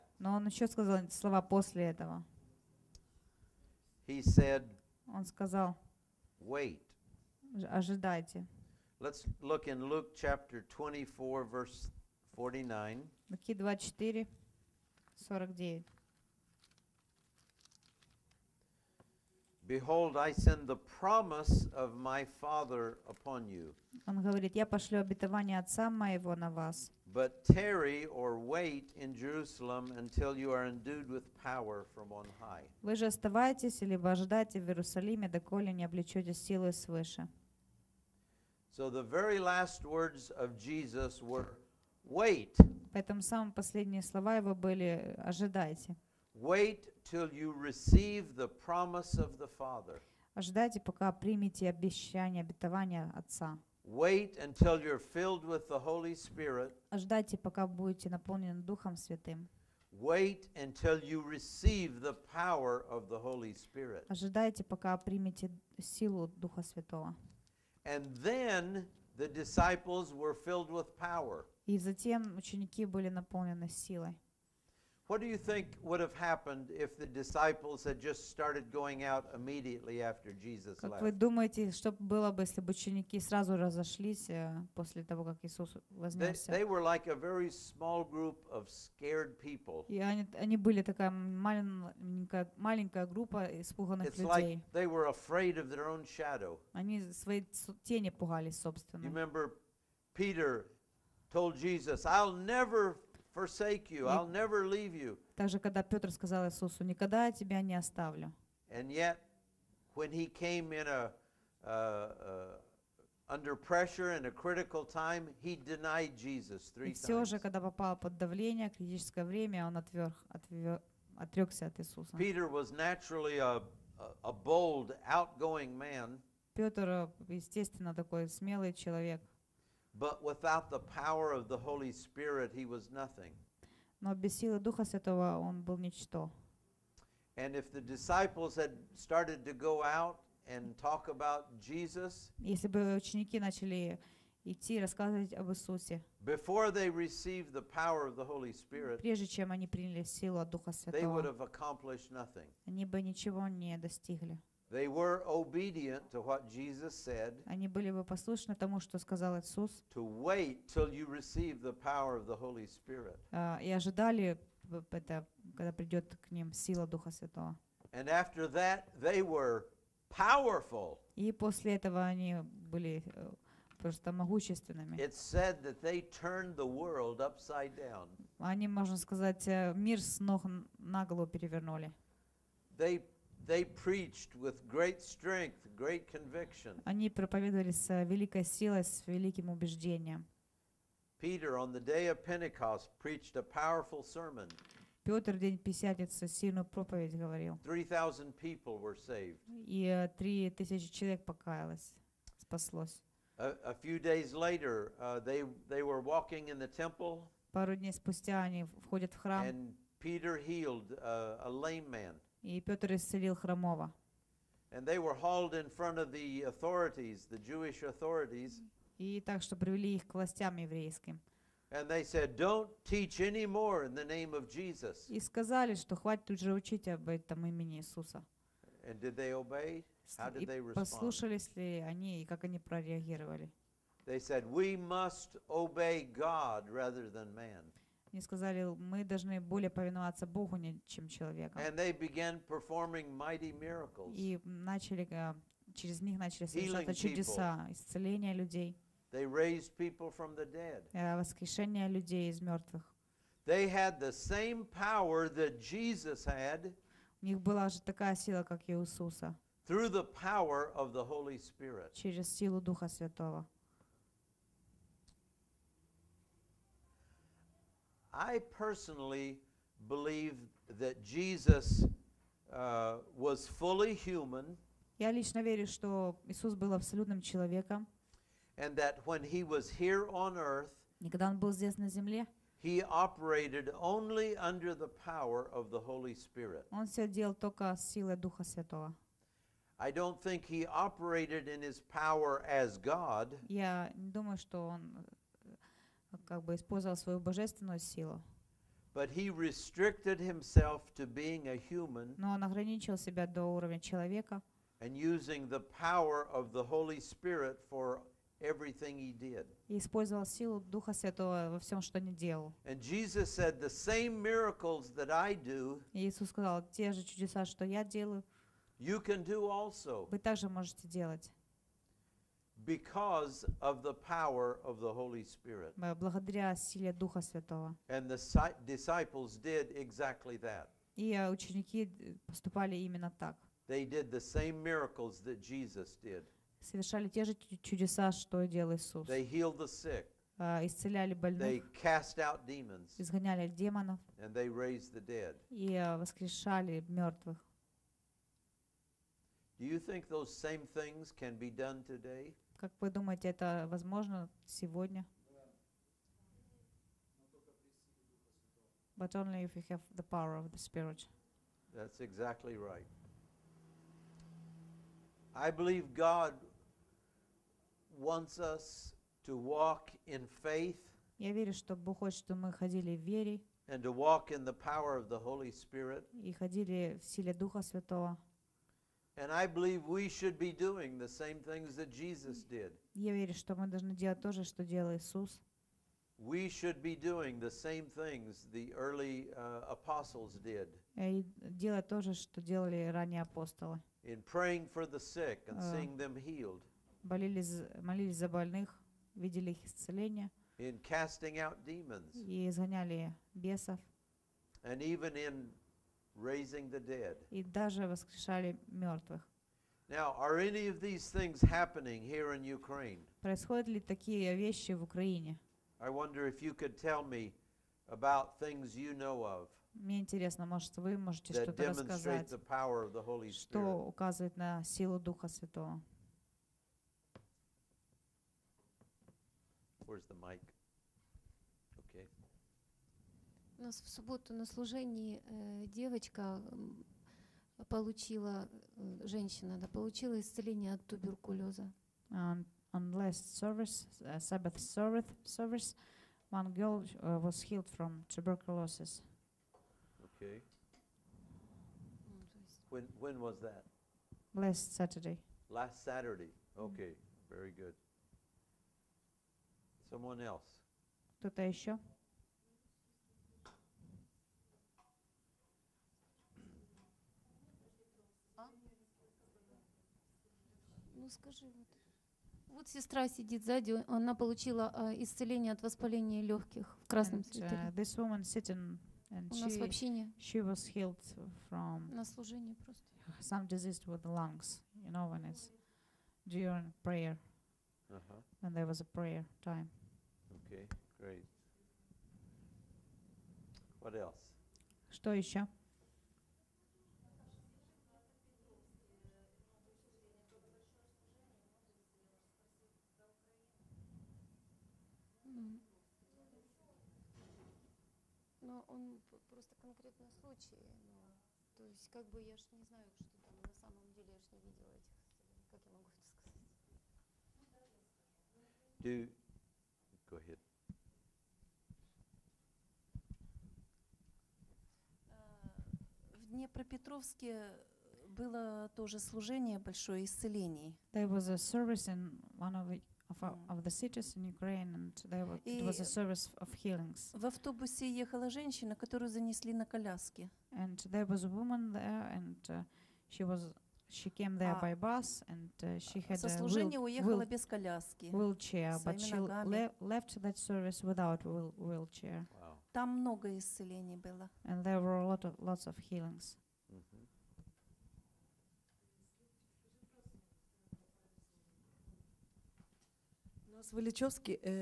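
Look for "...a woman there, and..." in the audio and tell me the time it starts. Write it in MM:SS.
09:01.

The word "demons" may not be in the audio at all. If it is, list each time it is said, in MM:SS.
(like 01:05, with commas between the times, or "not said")
05:42, 06:41.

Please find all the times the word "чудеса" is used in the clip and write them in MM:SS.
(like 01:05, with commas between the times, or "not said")
04:06, 05:17, 05:37.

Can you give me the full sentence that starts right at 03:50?
Послушались ли они и как они прореагировали?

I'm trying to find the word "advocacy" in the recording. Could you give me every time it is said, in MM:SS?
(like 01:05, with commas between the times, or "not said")
not said.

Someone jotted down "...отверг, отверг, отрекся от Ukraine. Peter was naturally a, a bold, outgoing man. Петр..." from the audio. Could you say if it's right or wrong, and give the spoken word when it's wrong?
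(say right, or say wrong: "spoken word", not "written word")
wrong: "Иисуса", not "Ukraine".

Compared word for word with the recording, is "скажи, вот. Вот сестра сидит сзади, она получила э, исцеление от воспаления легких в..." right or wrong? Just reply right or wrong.
right.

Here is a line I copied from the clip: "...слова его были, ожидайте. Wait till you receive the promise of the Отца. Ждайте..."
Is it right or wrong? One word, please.
wrong.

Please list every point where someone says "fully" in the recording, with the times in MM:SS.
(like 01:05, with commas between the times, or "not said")
04:33.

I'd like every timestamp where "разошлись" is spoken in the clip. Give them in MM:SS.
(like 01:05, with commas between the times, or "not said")
01:23.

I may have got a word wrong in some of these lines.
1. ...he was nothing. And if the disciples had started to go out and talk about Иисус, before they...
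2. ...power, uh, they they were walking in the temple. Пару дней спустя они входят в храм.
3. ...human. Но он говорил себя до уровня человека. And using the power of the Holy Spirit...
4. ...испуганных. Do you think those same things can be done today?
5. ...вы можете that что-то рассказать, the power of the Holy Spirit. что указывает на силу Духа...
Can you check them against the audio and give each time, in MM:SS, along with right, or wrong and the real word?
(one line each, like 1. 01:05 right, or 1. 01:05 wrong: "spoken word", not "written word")
1. 02:12 wrong: "Jesus", not "Иисус"
2. 03:24 wrong: "later", not "power"
3. 05:01 wrong: "ограничил", not "говорил"
4. 05:46 wrong: "мертвых", not "испуганных"
5. 07:00 right.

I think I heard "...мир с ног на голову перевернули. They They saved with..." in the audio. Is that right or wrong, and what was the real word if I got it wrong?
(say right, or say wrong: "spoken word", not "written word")
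wrong: "preached", not "saved".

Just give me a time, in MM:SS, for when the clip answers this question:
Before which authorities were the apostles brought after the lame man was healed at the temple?
03:37.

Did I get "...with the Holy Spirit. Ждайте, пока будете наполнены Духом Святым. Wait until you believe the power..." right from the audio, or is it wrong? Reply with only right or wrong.
wrong.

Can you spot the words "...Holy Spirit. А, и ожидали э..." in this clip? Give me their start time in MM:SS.
02:42.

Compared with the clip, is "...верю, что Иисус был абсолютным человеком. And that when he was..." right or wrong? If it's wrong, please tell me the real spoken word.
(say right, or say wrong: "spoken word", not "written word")
right.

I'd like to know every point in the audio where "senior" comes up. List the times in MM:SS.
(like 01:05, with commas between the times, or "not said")
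not said.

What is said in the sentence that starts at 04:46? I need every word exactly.
Он все делал только с силой Духа Святого.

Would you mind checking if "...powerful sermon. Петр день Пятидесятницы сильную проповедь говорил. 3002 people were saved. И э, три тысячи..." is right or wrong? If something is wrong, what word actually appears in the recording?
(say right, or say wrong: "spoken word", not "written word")
wrong: "3000", not "3002".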